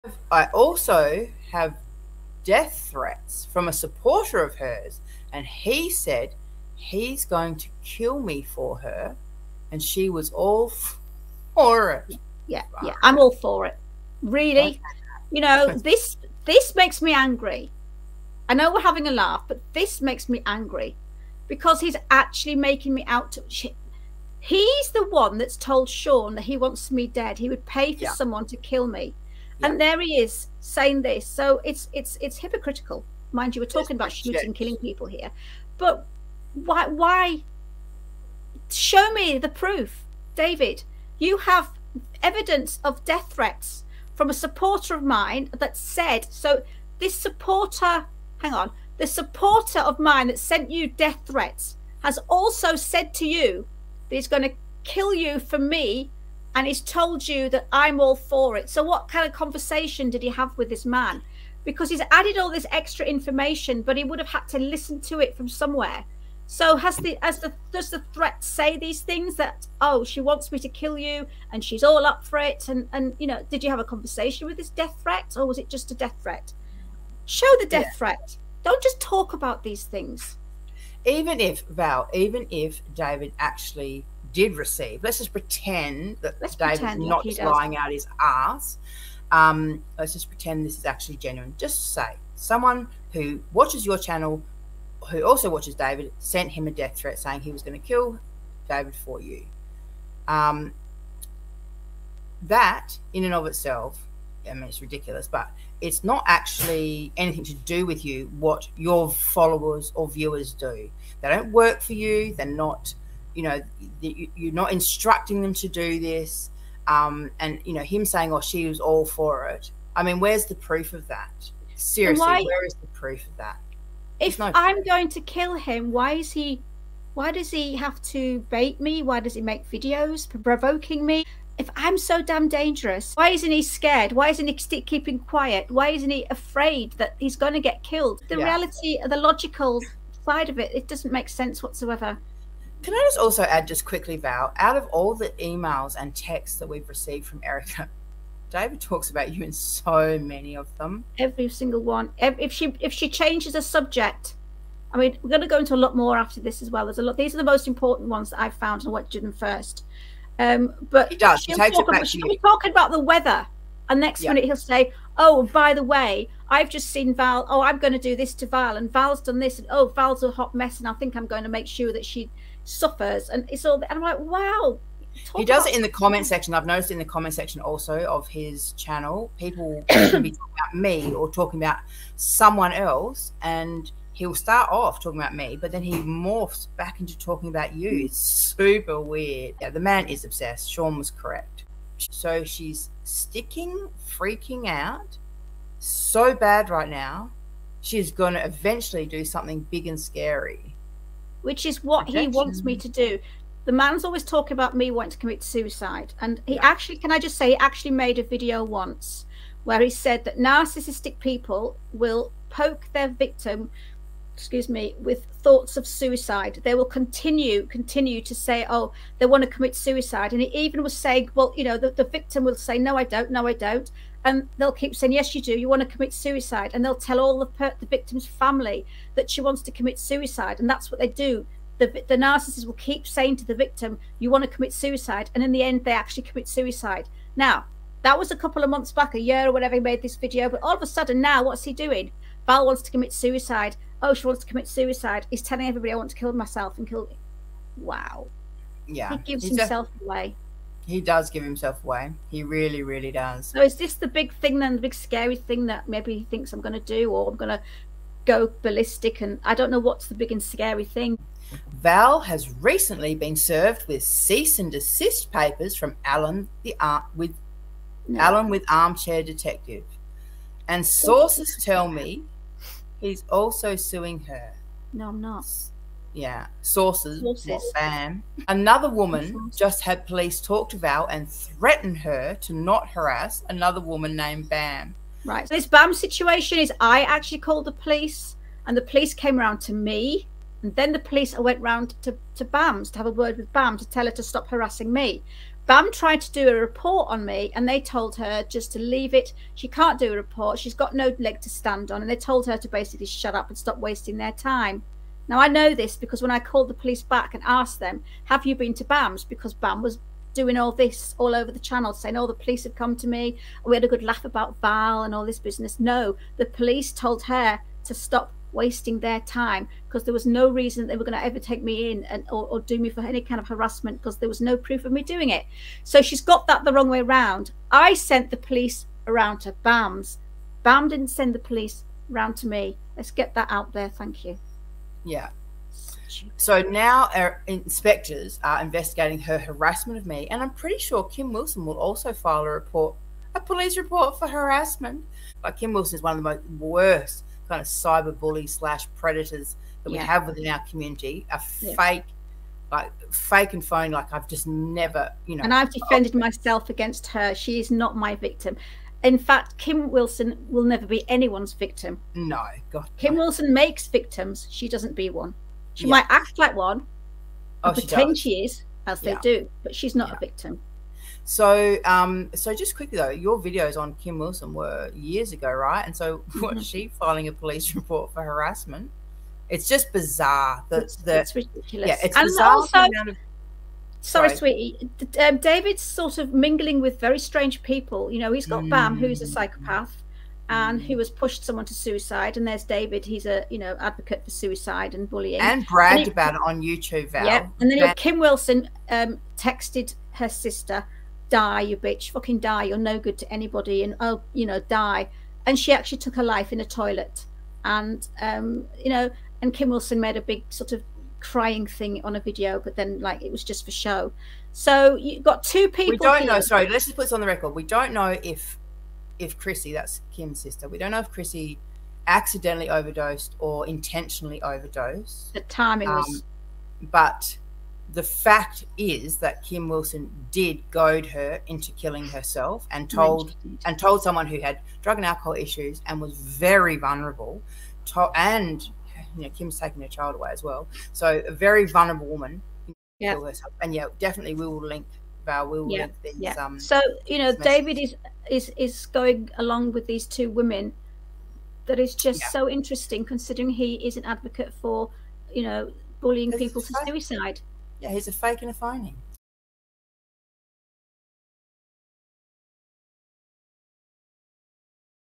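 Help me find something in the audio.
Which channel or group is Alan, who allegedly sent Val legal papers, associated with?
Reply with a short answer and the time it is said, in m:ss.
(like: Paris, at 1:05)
Armchair Detective, at 4:28.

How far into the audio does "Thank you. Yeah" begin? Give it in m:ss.
5:33.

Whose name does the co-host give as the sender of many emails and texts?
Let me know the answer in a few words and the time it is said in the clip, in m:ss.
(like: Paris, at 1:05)
Erica, at 2:27.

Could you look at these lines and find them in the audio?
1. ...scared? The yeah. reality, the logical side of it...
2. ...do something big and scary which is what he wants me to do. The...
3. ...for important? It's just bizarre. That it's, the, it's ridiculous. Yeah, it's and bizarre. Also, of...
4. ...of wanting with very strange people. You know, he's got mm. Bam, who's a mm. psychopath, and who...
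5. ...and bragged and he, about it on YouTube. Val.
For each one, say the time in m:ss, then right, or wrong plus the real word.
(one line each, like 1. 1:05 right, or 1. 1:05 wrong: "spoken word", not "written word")
1. 2:17 wrong: "killed", not "scared"
2. 3:19 right
3. 6:18 wrong: "harassment", not "important"
4. 6:26 wrong: "mingling", not "wanting"
5. 6:35 right.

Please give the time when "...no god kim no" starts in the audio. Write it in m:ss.
6:02.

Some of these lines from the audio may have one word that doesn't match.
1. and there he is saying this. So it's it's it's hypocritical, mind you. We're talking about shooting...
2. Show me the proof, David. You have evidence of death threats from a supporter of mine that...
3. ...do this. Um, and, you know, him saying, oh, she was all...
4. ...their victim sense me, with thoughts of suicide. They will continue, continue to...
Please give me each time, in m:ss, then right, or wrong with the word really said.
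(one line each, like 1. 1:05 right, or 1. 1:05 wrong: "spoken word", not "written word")
1. 0:29 right
2. 0:38 right
3. 1:55 right
4. 3:32 wrong: "excuse", not "sense".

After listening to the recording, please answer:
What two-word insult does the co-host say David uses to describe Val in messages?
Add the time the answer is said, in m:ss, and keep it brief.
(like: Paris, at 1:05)
hot mess, at 2:50.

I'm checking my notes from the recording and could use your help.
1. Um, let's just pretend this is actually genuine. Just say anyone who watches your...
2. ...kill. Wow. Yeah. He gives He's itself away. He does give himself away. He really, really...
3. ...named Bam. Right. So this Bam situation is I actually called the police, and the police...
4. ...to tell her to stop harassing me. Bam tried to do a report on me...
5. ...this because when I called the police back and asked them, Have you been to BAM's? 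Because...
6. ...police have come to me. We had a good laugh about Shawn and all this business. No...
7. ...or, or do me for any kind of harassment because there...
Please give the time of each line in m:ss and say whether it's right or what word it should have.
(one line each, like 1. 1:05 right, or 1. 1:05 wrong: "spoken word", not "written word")
1. 1:29 wrong: "someone", not "anyone"
2. 4:06 wrong: "himself", not "itself"
3. 4:44 right
4. 4:53 right
5. 5:05 right
6. 5:12 wrong: "Val", not "Shawn"
7. 5:22 right.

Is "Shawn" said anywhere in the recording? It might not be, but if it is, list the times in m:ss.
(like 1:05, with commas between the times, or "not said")
0:25, 3:10.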